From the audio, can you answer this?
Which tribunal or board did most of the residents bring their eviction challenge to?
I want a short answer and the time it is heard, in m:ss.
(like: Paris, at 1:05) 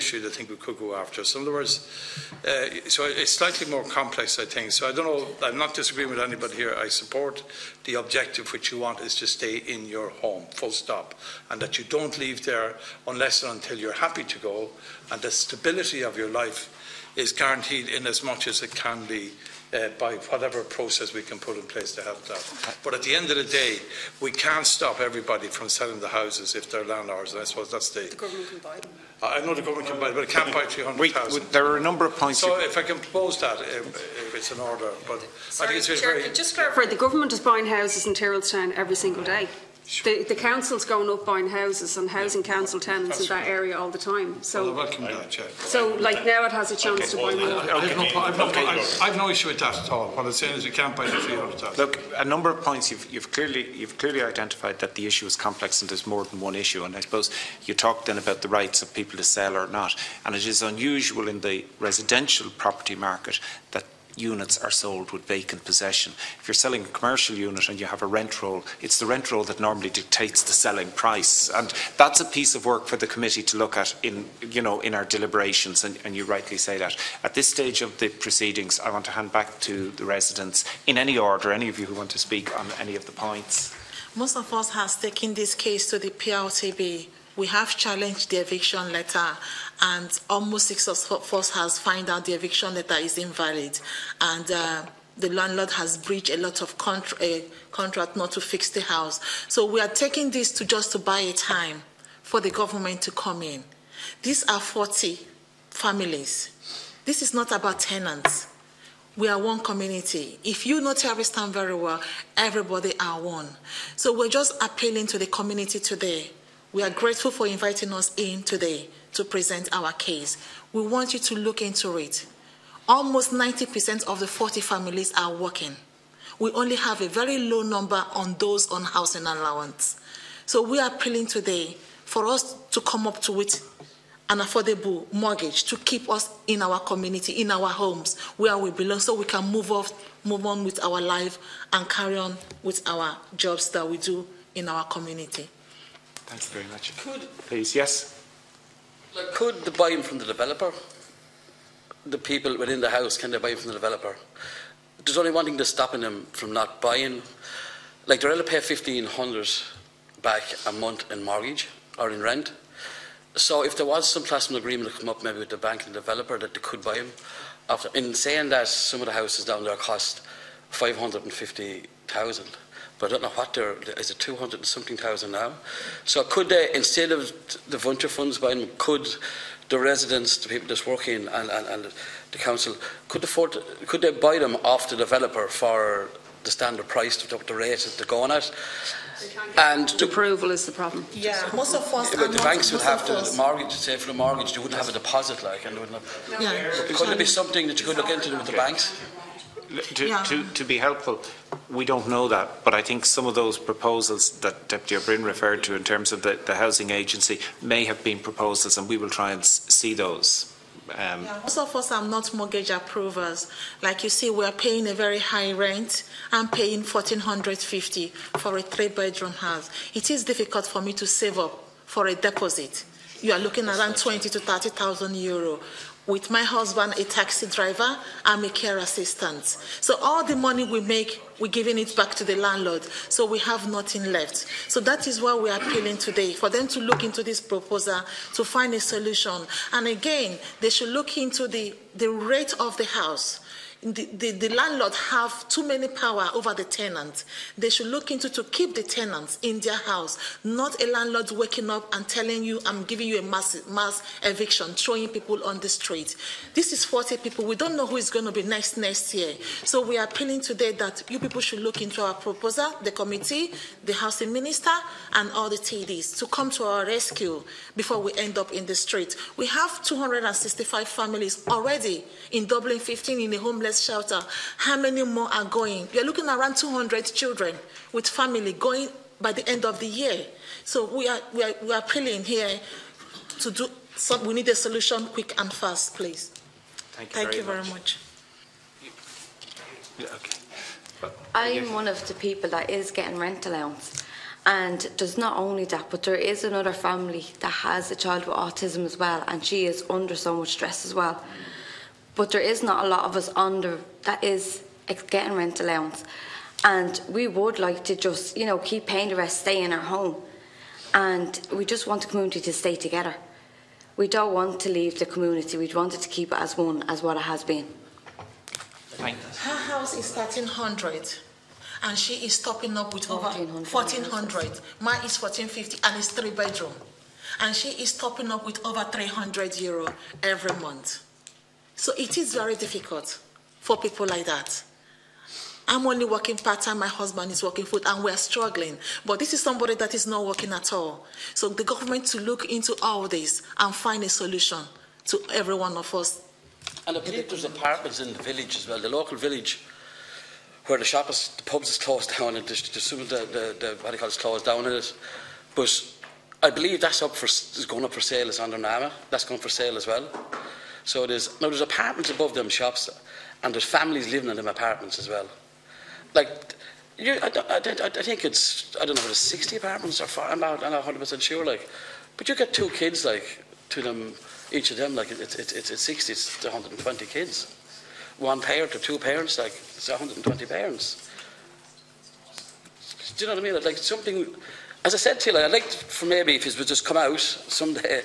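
PRTB, at 1:26.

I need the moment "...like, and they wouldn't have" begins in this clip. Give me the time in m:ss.
3:15.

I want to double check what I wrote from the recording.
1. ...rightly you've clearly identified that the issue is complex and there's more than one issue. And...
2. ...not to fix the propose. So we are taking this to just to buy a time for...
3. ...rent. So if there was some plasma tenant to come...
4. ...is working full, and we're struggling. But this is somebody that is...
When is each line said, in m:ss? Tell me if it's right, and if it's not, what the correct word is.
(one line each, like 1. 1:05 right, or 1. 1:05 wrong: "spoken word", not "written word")
1. 0:53 wrong: "clearly", not "rightly"
2. 1:38 wrong: "house", not "propose"
3. 2:42 wrong: "agreement", not "tenant"
4. 5:37 right.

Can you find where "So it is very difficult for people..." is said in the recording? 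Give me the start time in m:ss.
5:31.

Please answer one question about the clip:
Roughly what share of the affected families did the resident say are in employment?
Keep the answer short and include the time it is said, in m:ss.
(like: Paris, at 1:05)
90%, at 2:03.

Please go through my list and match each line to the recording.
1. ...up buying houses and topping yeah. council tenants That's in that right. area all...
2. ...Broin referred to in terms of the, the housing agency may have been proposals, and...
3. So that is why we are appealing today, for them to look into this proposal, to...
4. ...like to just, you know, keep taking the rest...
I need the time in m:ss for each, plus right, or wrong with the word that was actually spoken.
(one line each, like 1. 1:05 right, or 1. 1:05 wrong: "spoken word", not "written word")
1. 0:41 wrong: "housing", not "topping"
2. 3:25 right
3. 3:54 right
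4. 5:07 wrong: "paying", not "taking".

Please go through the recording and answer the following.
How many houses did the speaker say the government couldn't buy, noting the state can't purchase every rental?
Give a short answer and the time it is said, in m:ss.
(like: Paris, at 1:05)
300,000, at 0:30.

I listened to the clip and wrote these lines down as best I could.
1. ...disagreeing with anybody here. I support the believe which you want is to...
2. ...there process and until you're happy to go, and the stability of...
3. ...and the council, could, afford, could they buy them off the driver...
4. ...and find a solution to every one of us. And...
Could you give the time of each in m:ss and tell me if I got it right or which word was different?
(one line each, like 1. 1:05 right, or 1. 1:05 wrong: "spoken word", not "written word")
1. 0:05 wrong: "objective", not "believe"
2. 0:12 wrong: "unless", not "process"
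3. 3:01 wrong: "developer", not "driver"
4. 5:43 right.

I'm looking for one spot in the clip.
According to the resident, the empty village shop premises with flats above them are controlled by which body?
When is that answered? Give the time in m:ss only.
5:58.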